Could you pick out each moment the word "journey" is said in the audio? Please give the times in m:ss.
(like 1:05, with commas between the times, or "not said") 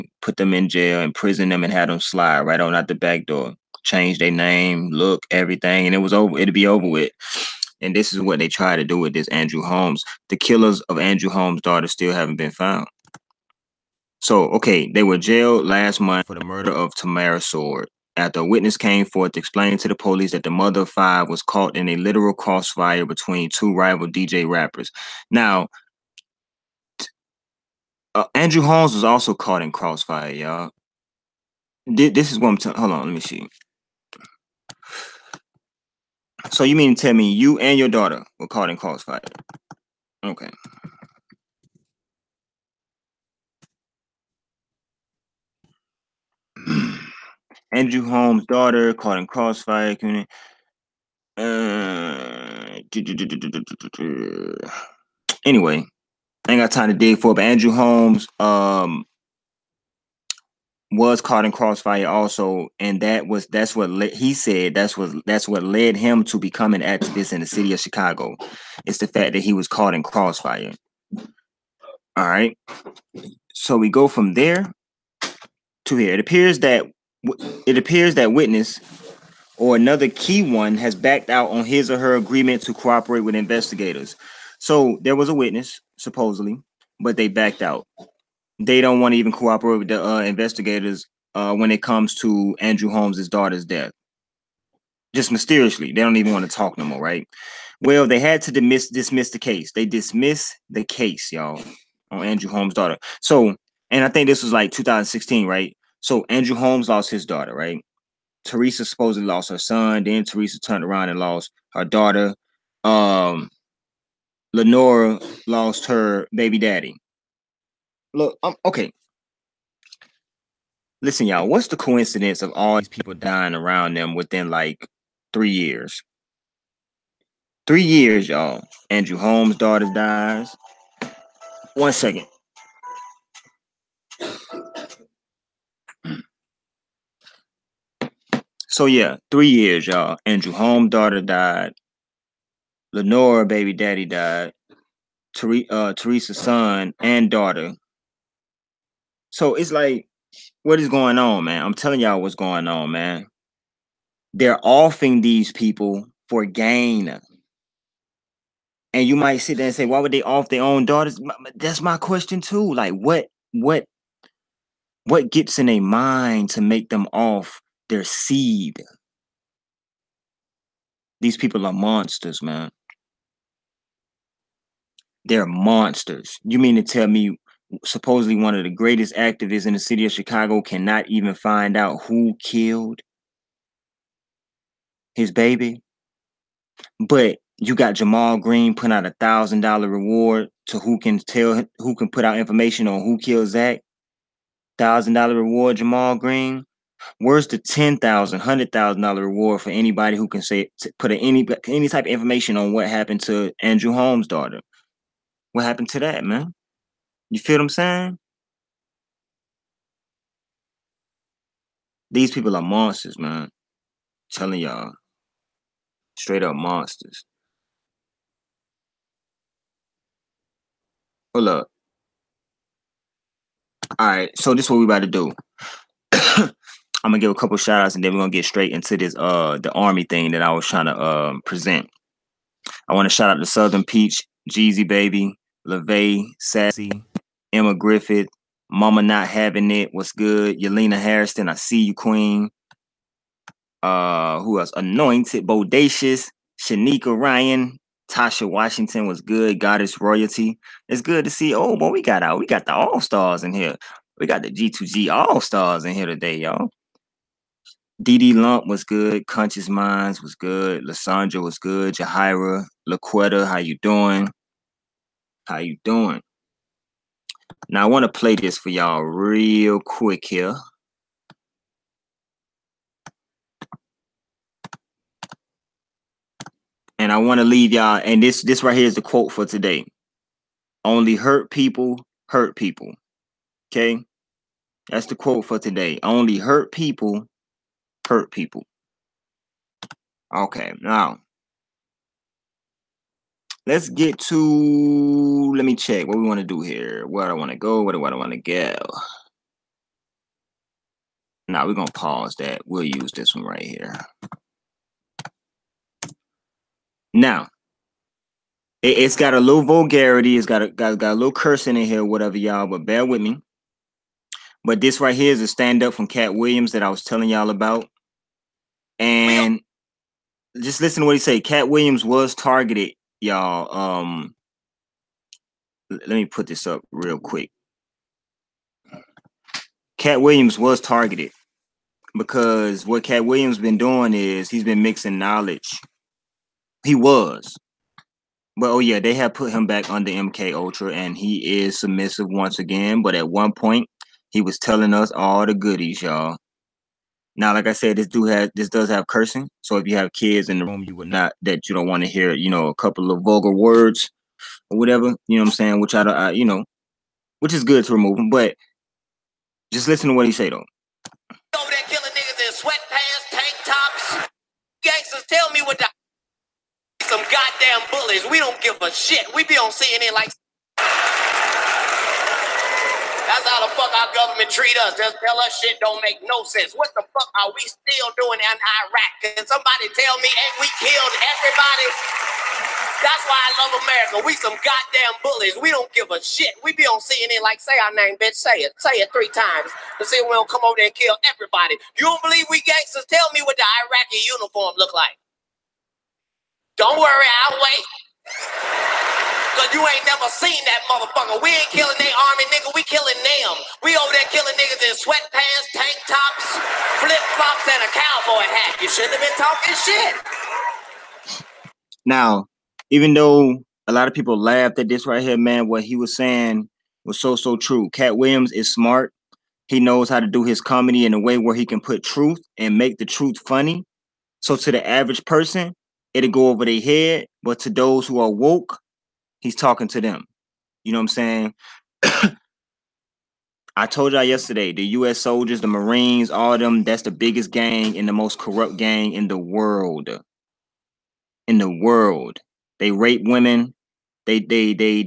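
not said.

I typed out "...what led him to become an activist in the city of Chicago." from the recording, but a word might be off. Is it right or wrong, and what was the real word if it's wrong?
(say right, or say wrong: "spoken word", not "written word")
right.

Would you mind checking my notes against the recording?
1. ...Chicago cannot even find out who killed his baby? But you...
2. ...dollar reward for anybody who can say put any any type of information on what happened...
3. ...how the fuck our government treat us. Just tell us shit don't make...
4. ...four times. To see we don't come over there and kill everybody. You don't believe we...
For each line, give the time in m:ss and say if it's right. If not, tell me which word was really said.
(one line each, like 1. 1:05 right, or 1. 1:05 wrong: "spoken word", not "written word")
1. 3:00 right
2. 3:19 right
3. 6:13 right
4. 6:29 wrong: "three", not "four".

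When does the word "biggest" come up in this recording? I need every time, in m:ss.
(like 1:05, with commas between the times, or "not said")
7:17.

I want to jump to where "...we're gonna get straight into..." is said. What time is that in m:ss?
3:48.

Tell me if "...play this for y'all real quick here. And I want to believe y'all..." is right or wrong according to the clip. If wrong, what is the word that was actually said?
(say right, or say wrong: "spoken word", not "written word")
wrong: "leave", not "believe".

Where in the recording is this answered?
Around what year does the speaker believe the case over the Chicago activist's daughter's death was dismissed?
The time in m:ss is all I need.
1:44.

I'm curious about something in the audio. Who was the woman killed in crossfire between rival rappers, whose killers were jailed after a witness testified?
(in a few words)
Tamara Sword.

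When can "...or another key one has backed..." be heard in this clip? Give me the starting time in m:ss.
1:19.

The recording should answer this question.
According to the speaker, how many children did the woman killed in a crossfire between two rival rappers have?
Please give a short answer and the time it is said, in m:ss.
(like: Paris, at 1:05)
5, at 0:20.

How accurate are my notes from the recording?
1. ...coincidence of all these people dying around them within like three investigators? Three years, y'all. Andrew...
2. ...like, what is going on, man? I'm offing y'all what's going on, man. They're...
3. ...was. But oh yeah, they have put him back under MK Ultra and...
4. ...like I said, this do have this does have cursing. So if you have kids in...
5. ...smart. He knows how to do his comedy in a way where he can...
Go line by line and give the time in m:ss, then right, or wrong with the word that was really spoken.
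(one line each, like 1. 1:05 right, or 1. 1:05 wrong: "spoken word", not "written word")
1. 2:01 wrong: "years", not "investigators"
2. 2:29 wrong: "telling", not "offing"
3. 5:36 right
4. 5:47 right
5. 6:58 right.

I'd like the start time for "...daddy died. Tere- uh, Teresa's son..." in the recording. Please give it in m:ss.
2:23.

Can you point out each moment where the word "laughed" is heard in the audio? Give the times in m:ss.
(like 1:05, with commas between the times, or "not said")
6:54.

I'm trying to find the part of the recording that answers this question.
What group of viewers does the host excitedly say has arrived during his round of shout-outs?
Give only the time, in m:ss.
4:14.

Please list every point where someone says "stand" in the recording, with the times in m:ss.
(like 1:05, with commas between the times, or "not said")
5:15.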